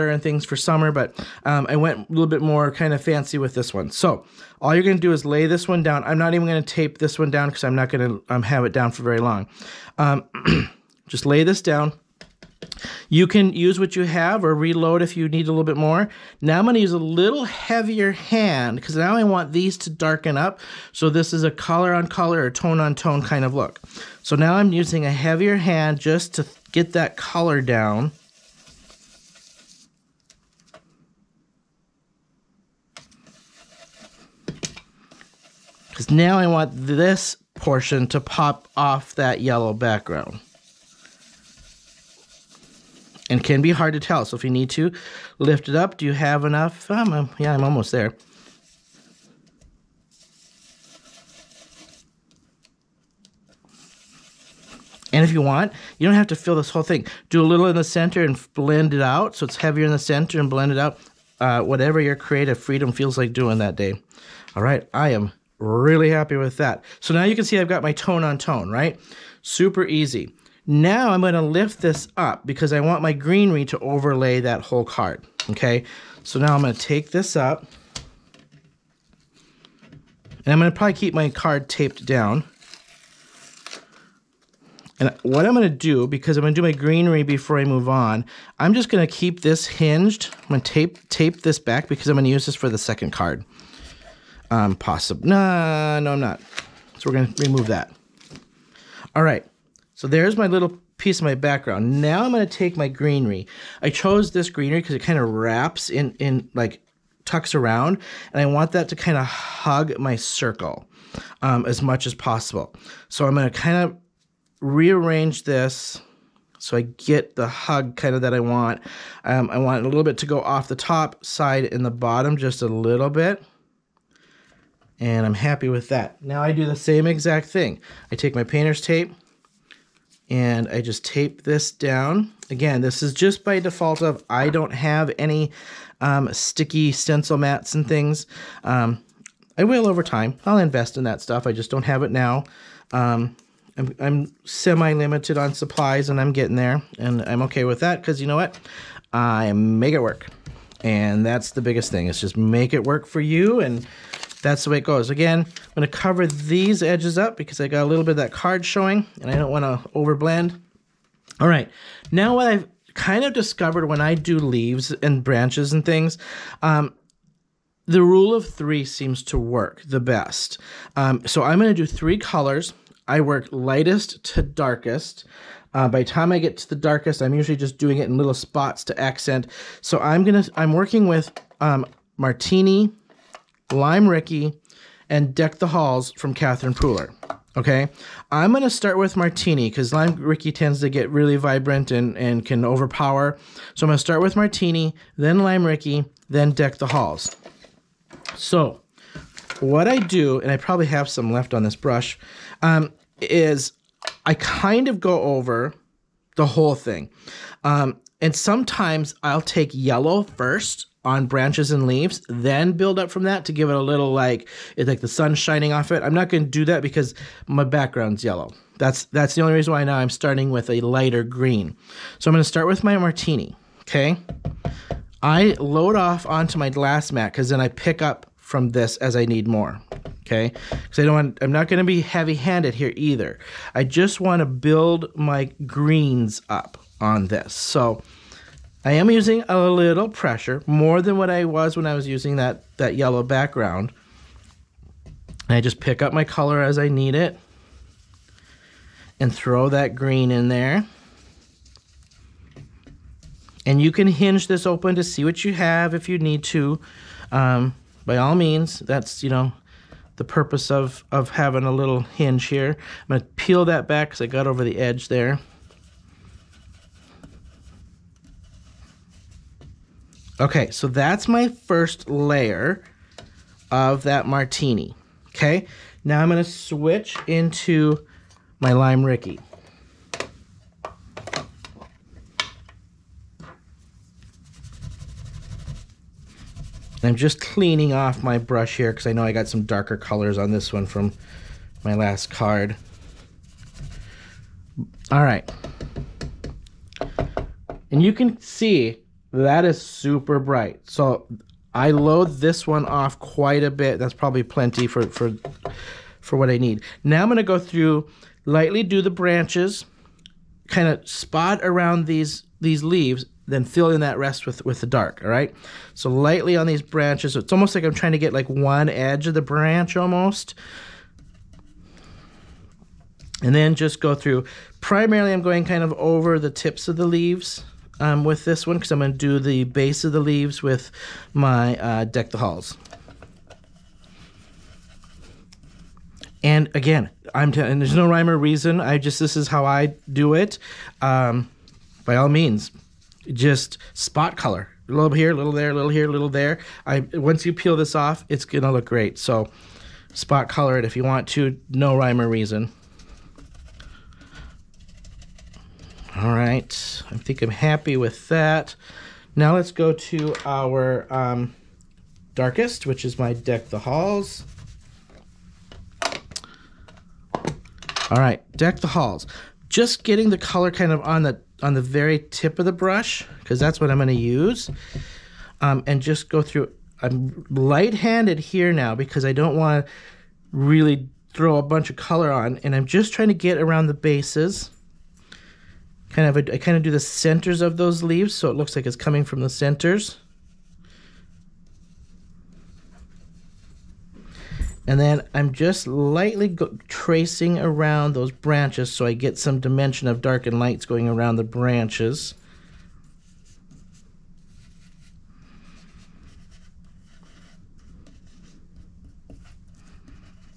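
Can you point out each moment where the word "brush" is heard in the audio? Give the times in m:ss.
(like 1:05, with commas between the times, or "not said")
3:21, 4:48, 6:12.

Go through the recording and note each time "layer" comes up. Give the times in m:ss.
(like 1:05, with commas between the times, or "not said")
4:32.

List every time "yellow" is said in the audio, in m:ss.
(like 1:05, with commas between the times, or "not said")
0:39, 3:29, 3:38, 4:02.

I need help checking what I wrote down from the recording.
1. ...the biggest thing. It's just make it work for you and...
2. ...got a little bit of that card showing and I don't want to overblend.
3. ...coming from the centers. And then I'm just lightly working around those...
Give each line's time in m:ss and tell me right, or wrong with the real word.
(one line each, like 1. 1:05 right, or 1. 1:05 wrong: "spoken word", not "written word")
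1. 2:31 right
2. 2:37 right
3. 6:28 wrong: "tracing", not "working".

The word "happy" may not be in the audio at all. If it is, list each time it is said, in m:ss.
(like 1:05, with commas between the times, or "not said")
1:06, 2:05, 5:57.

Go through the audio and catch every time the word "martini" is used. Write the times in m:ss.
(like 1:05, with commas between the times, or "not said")
3:02, 3:09, 3:14, 3:42, 4:34.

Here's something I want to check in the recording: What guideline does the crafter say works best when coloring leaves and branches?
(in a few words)
The rule of three.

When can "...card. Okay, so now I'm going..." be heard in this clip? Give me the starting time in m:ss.
1:14.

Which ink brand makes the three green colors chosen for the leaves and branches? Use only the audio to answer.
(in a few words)
Catherine Pooler.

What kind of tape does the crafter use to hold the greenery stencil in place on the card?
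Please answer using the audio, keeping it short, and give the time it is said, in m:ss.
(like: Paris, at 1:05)
Painter's tape, at 2:08.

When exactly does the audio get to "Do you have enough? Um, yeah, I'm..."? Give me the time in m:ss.
0:45.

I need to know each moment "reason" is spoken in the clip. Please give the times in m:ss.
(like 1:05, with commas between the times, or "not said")
3:39, 5:38, 5:52.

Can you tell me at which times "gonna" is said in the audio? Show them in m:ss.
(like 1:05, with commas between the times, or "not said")
3:00, 3:08, 3:13, 5:48.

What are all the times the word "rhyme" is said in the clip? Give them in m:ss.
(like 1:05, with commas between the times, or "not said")
5:38, 5:51.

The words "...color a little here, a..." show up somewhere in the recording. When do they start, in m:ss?
5:44.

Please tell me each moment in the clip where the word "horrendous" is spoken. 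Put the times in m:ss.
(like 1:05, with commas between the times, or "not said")
not said.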